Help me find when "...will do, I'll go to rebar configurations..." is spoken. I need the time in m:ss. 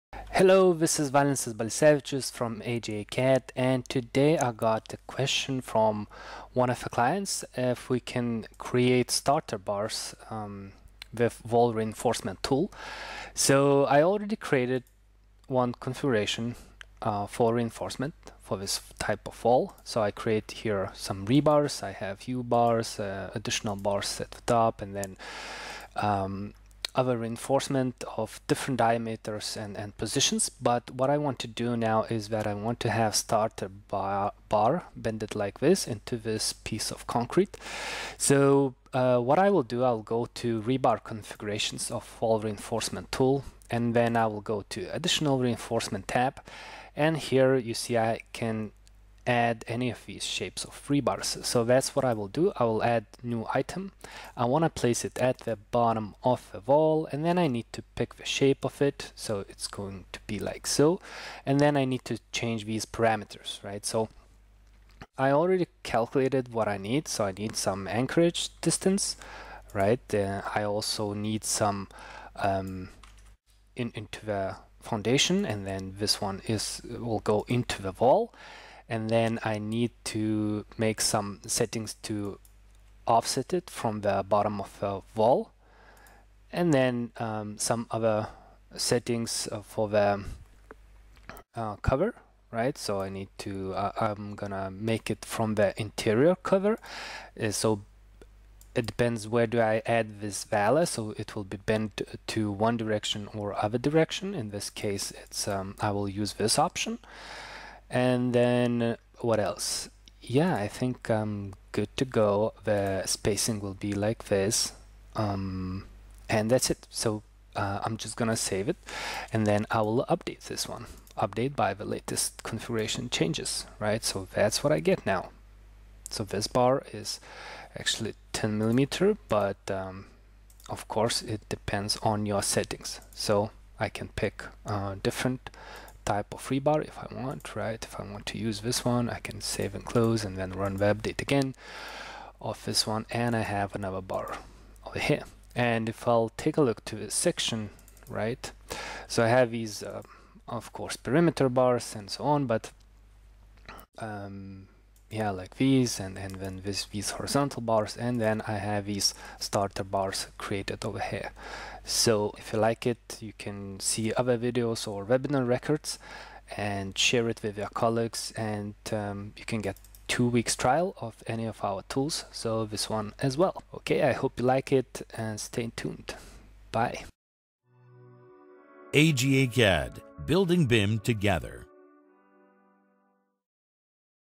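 0:39.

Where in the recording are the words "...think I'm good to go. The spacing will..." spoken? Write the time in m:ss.
1:50.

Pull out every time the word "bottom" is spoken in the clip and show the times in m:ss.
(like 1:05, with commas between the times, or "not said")
0:55, 1:24.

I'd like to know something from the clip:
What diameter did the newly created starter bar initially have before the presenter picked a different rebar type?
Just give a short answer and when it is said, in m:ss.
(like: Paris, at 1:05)
10 millimeter, at 2:08.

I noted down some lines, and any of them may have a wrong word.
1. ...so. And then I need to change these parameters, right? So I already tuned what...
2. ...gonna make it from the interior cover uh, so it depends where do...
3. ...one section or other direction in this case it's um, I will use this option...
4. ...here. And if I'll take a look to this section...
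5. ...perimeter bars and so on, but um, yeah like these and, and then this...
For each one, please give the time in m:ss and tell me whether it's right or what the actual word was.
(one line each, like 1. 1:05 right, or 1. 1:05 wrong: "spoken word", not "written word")
1. 1:00 wrong: "calculated", not "tuned"
2. 1:34 right
3. 1:42 wrong: "direction", not "section"
4. 2:24 right
5. 2:30 right.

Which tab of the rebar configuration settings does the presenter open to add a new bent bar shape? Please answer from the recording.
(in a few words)
additional reinforcement.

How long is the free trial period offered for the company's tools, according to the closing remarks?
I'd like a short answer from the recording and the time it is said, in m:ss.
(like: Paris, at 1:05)
2 weeks, at 2:50.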